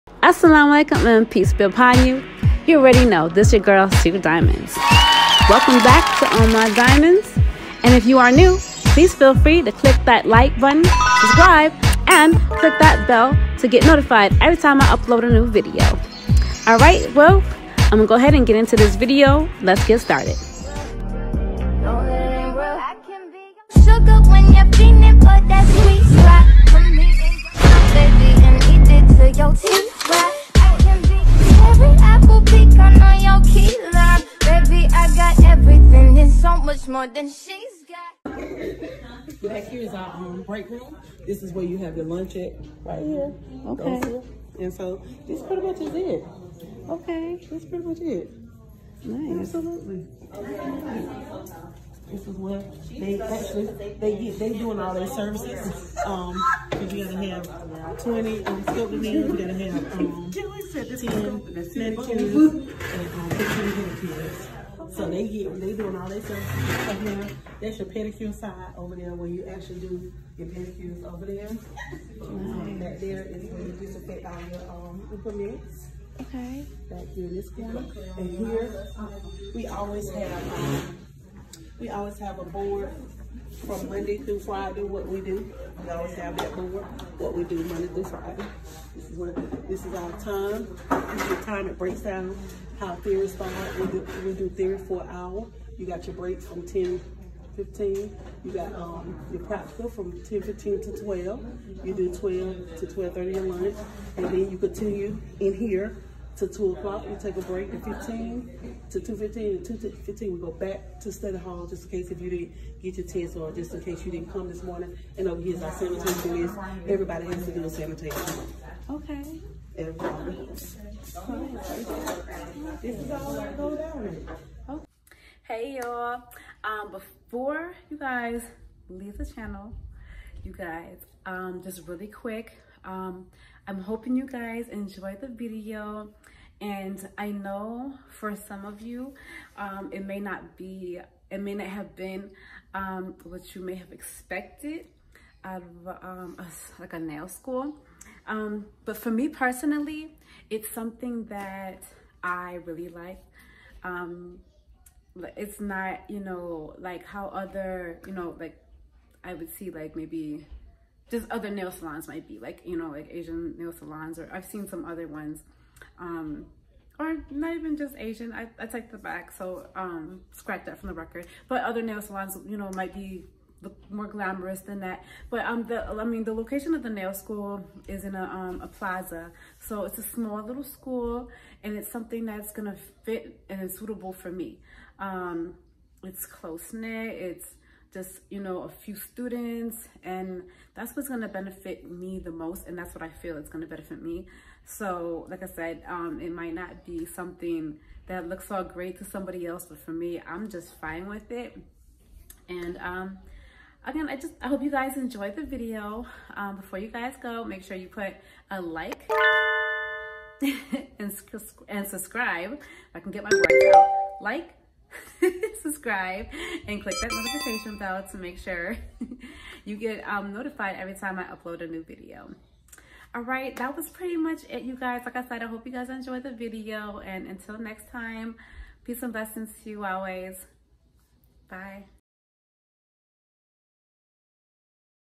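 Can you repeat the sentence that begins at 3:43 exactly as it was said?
All right, that was pretty much it, you guys.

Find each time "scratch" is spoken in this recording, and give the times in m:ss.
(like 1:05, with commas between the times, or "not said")
2:50.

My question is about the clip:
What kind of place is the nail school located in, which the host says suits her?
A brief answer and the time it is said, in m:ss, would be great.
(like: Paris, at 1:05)
a plaza, at 2:58.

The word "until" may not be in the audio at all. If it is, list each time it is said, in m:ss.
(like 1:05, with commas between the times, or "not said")
3:47.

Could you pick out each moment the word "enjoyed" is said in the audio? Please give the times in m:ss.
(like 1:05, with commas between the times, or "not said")
2:14, 3:24, 3:45.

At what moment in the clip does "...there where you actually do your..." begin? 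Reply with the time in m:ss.
1:08.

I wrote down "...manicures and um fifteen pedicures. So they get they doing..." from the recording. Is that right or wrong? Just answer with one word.
right.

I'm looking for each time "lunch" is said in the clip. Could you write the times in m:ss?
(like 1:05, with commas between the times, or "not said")
0:42, 1:43.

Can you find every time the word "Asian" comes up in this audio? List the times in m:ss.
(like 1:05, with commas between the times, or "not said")
2:43, 2:47.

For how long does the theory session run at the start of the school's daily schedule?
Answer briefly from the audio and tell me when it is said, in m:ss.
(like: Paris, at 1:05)
an hour, at 1:35.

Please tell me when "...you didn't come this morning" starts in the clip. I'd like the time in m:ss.
1:54.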